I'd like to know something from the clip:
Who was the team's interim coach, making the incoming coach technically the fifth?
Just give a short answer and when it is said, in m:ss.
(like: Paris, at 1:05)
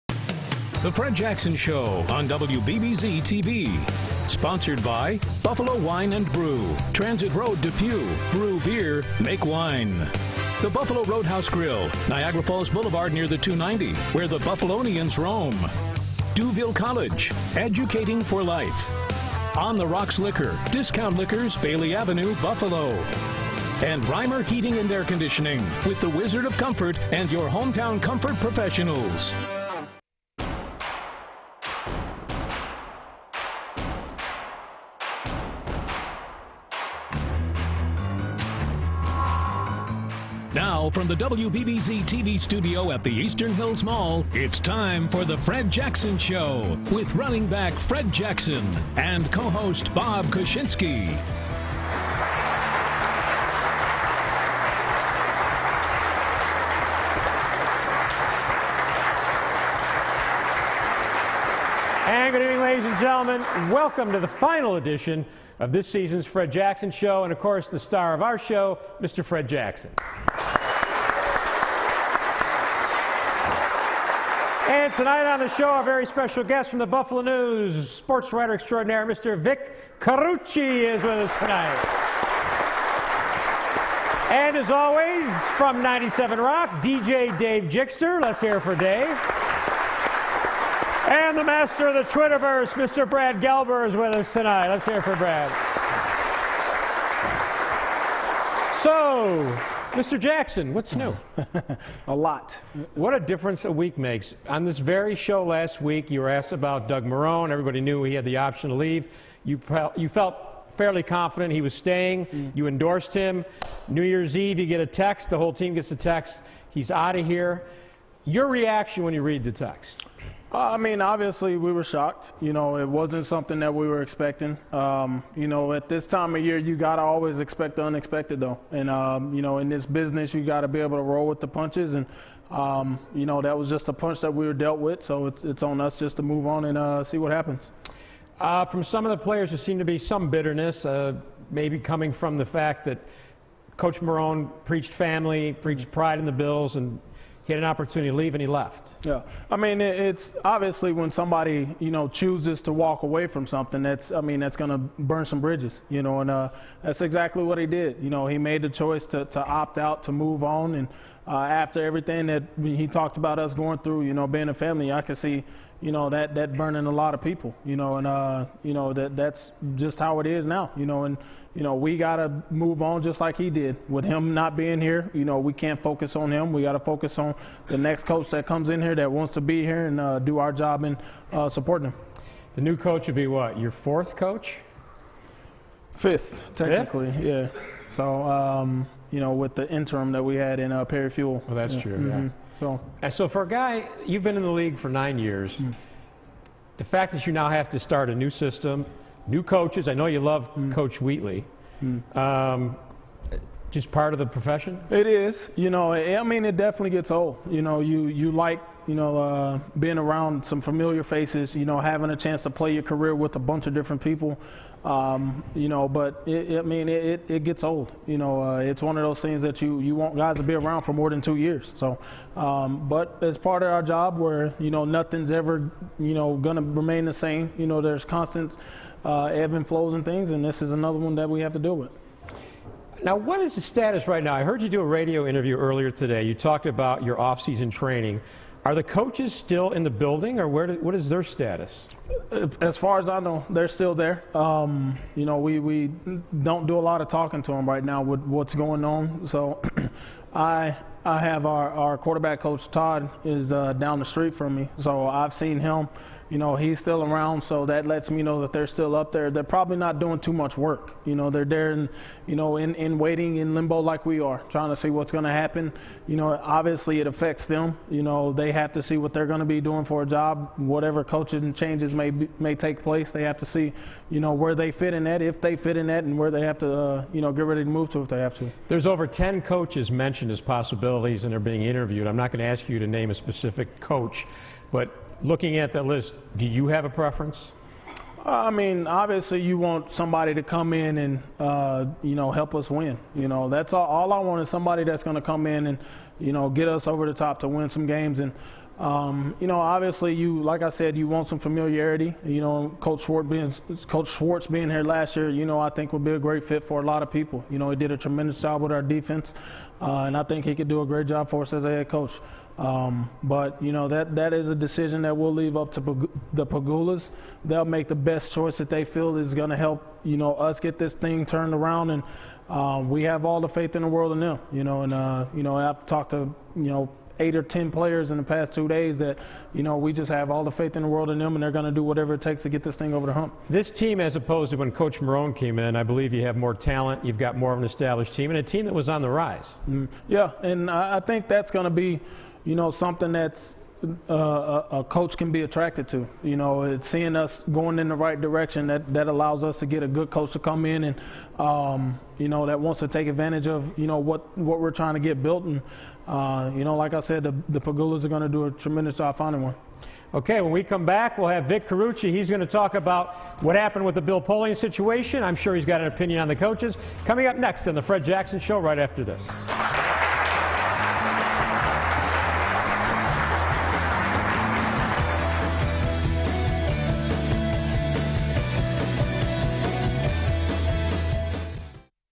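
Perry Fewell, at 3:10.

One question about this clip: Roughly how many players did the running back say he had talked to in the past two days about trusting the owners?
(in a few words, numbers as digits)
8 or 10.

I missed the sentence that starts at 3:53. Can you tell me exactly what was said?
Now, what is the status right now?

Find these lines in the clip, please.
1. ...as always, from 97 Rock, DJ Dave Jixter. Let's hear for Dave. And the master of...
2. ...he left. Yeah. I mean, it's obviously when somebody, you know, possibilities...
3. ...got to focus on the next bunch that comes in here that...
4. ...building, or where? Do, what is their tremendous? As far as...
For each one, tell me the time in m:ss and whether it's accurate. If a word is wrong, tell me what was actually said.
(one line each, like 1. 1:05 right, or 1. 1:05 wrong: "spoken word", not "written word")
1. 1:24 right
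2. 2:28 wrong: "chooses", not "possibilities"
3. 2:56 wrong: "coach", not "bunch"
4. 3:59 wrong: "status", not "tremendous".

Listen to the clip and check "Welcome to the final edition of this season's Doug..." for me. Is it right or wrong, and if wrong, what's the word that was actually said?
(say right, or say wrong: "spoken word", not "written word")
wrong: "Fred", not "Doug".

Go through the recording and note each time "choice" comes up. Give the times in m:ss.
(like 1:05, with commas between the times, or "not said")
2:38, 5:18.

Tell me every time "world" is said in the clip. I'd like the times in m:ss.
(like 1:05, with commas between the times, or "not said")
5:23, 5:30.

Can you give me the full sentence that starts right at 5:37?
You've got more of an established team and a team that was on the rise.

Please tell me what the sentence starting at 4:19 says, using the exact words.
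They're probably not doing too much work.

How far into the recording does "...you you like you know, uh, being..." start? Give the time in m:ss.
3:27.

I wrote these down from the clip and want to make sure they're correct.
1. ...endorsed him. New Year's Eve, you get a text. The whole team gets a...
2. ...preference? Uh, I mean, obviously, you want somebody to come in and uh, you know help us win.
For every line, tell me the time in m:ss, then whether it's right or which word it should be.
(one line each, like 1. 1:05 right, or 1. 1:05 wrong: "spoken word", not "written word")
1. 1:52 right
2. 4:46 right.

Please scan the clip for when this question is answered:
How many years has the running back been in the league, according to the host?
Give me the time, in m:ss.
3:14.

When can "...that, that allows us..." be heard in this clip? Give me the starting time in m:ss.
5:48.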